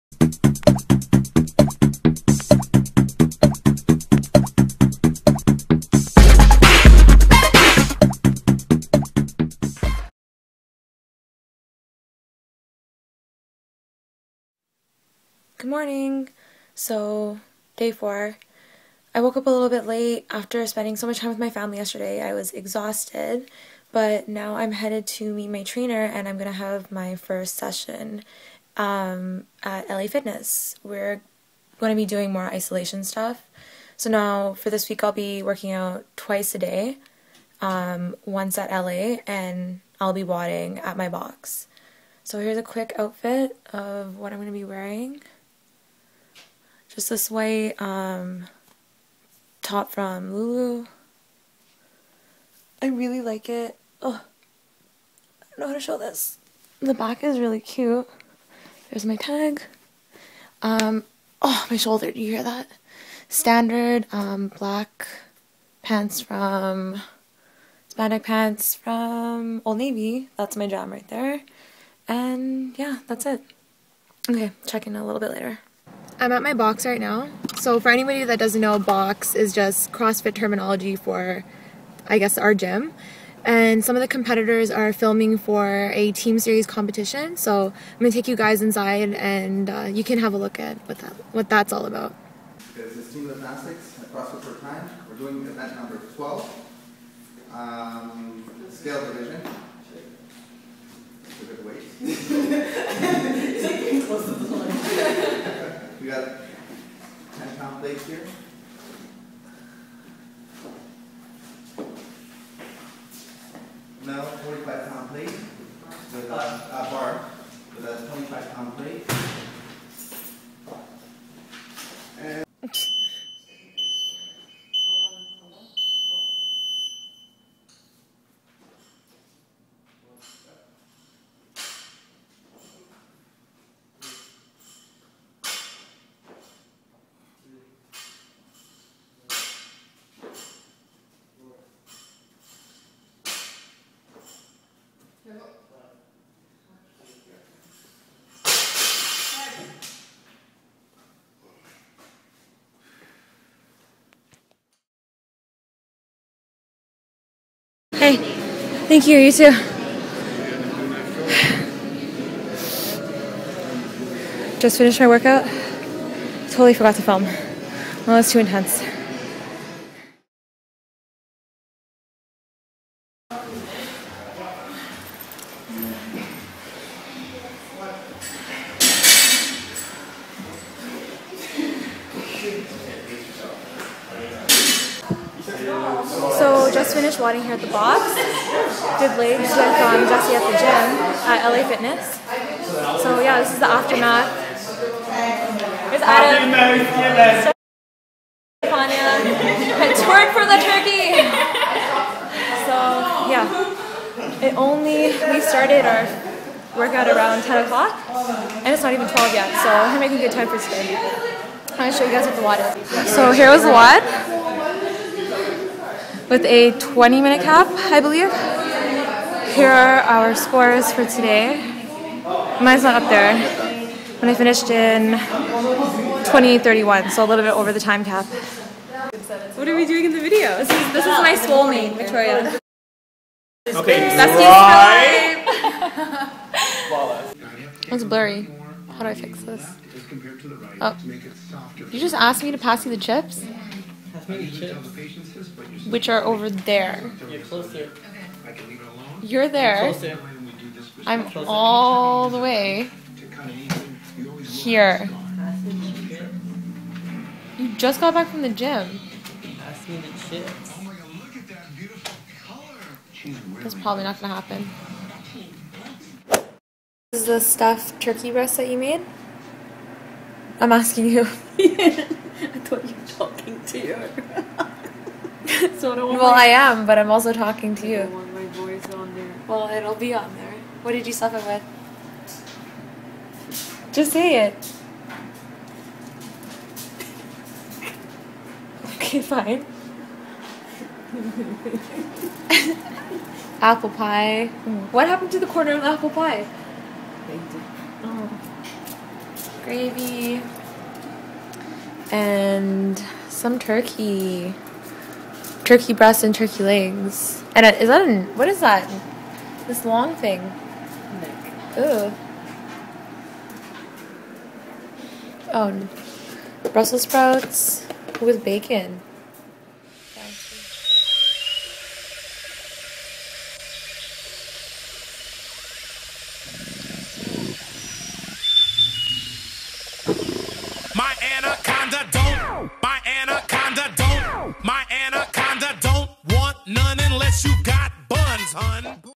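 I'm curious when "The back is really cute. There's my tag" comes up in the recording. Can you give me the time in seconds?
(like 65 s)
56 s.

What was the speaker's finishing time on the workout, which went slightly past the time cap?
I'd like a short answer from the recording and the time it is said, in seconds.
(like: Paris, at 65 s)
20:31, at 226 s.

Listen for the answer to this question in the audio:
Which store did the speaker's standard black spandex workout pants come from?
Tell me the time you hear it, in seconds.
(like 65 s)
69 s.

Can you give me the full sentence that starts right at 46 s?
Just this white um, top from Lulu.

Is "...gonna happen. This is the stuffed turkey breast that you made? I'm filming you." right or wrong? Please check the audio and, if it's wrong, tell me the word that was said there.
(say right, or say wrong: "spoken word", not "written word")
wrong: "asking", not "filming".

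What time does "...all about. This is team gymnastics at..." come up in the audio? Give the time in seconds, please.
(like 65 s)
91 s.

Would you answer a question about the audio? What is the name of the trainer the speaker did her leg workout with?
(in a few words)
Jesse.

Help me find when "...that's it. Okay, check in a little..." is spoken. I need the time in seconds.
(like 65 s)
73 s.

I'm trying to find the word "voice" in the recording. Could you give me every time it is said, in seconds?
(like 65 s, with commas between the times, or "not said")
278 s.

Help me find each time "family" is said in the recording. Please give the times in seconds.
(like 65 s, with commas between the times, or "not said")
21 s.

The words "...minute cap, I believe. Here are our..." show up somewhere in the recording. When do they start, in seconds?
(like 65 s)
217 s.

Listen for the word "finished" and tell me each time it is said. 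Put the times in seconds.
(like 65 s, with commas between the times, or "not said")
164 s, 186 s, 224 s.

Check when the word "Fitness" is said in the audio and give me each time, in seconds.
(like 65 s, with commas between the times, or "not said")
30 s, 191 s.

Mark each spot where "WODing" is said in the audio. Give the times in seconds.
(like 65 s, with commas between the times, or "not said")
40 s, 187 s.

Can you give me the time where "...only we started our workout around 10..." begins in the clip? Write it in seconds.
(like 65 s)
204 s.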